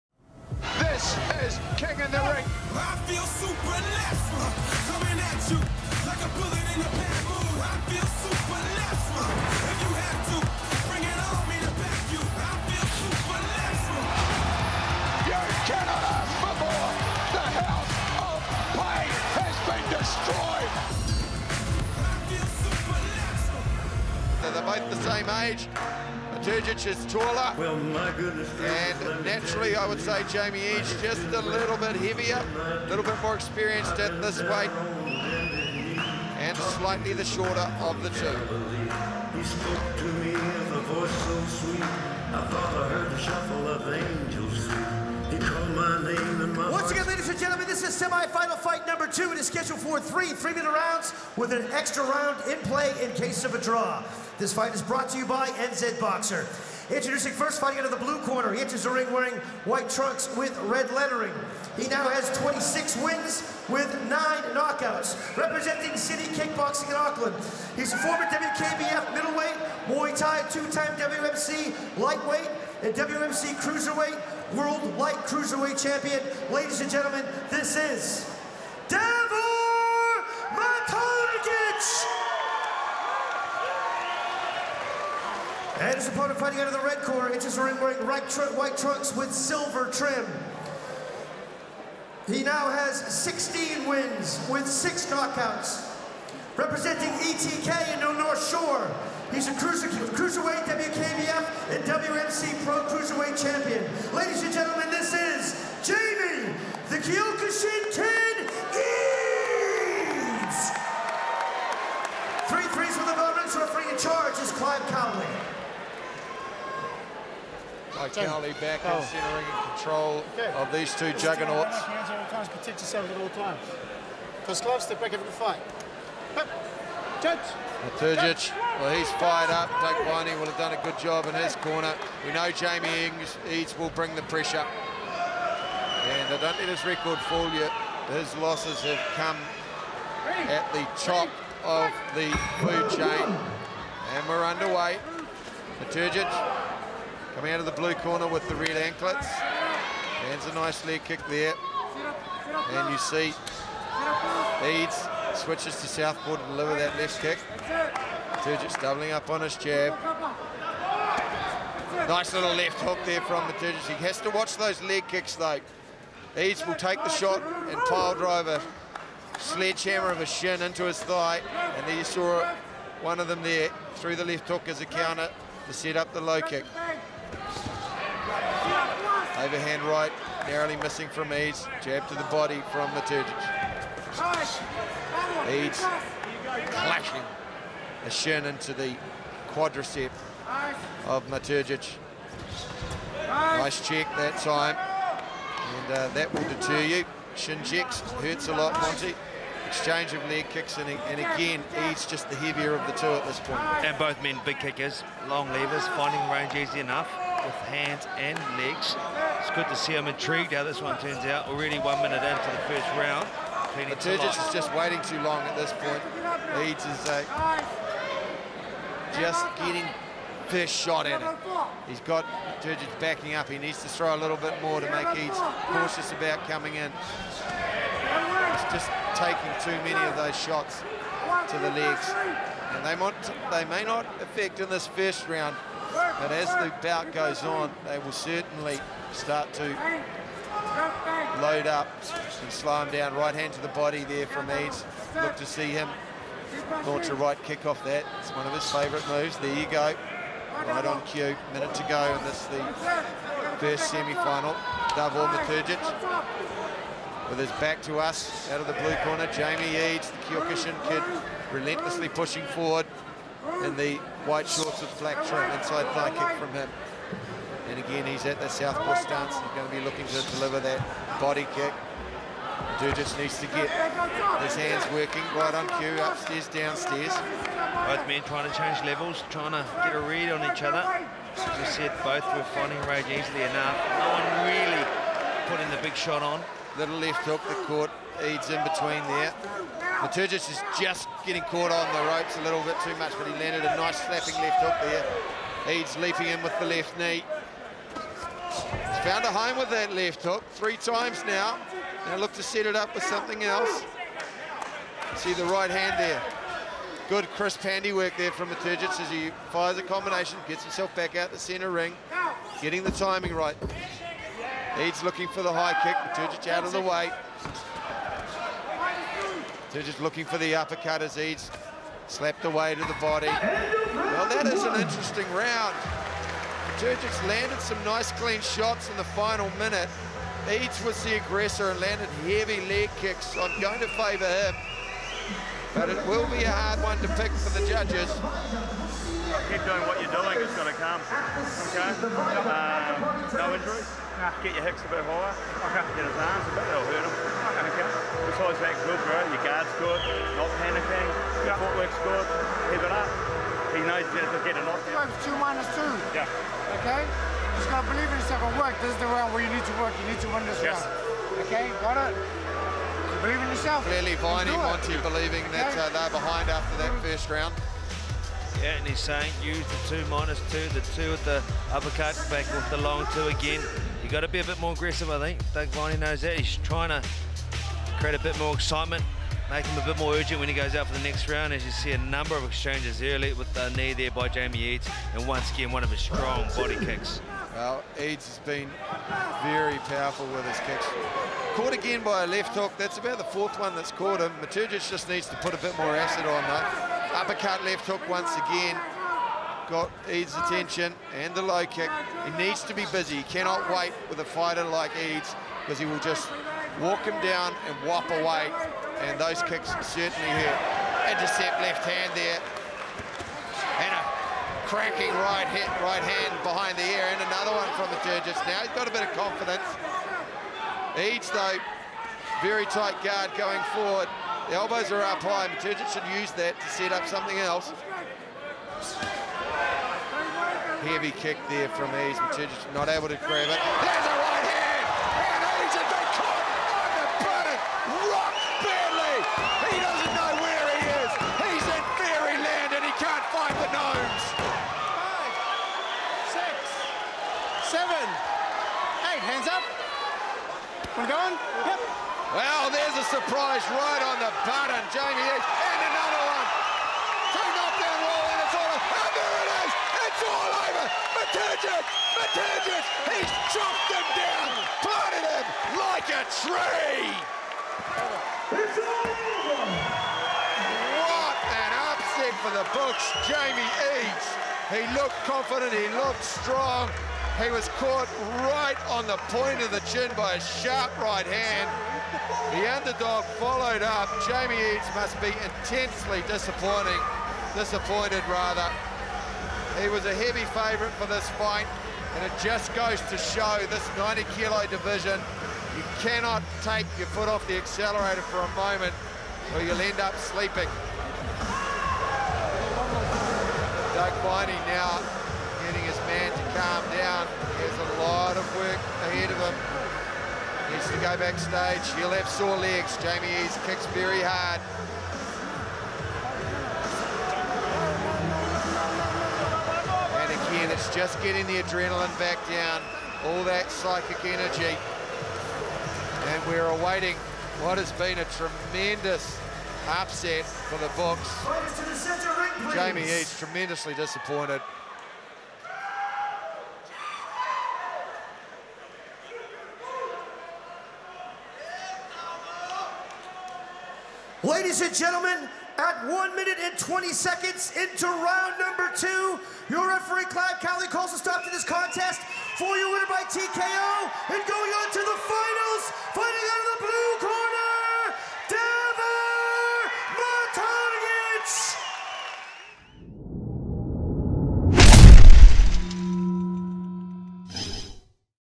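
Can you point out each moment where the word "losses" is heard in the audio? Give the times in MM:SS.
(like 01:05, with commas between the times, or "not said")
02:18.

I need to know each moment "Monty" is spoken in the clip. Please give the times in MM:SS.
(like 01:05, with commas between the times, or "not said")
03:18, 06:04.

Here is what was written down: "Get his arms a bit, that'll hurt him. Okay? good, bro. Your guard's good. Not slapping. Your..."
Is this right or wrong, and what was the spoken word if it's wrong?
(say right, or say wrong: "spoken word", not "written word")
wrong: "panicking", not "slapping".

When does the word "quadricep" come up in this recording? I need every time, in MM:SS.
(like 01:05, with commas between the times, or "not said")
03:09.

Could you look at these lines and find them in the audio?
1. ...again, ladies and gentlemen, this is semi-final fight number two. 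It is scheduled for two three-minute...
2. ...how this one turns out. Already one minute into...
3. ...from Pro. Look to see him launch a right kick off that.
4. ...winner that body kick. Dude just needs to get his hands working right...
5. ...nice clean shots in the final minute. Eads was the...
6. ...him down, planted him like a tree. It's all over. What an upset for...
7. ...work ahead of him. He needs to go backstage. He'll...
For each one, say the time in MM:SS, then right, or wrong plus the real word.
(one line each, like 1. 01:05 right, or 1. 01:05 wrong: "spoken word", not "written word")
1. 00:46 wrong: "three", not "two"
2. 03:30 right
3. 04:04 wrong: "Eads", not "Pro"
4. 04:30 wrong: "deliver", not "winner"
5. 05:27 right
6. 07:43 right
7. 08:28 right.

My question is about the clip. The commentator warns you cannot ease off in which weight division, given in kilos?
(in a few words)
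90 kilo.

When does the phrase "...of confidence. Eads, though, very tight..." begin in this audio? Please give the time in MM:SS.
06:59.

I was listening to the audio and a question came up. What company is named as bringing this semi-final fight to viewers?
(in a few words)
NZ Boxer.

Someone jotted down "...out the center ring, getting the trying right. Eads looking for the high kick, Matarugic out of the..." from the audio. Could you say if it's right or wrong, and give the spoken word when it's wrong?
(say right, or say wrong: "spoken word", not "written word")
wrong: "timing", not "trying".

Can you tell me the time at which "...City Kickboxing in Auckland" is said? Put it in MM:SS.
01:05.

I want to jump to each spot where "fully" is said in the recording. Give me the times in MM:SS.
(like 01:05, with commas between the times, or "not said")
not said.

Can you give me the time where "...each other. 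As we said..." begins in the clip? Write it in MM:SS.
04:40.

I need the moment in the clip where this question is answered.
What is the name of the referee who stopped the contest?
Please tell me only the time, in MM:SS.
09:10.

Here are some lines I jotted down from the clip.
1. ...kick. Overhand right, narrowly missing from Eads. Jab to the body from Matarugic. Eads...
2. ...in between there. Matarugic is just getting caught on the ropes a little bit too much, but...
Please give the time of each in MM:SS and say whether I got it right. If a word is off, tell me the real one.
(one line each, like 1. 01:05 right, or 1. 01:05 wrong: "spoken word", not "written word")
1. 02:56 right
2. 04:48 right.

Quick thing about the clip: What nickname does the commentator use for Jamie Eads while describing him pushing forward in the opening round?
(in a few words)
the Kyokushin kid.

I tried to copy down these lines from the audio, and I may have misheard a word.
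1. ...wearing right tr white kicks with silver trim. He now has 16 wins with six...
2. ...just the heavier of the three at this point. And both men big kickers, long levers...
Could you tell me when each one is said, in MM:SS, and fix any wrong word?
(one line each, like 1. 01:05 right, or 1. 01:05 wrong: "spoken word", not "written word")
1. 01:27 wrong: "trunks", not "kicks"
2. 03:22 wrong: "two", not "three".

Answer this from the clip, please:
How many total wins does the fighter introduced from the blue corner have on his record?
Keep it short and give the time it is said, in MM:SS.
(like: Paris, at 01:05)
26, at 01:02.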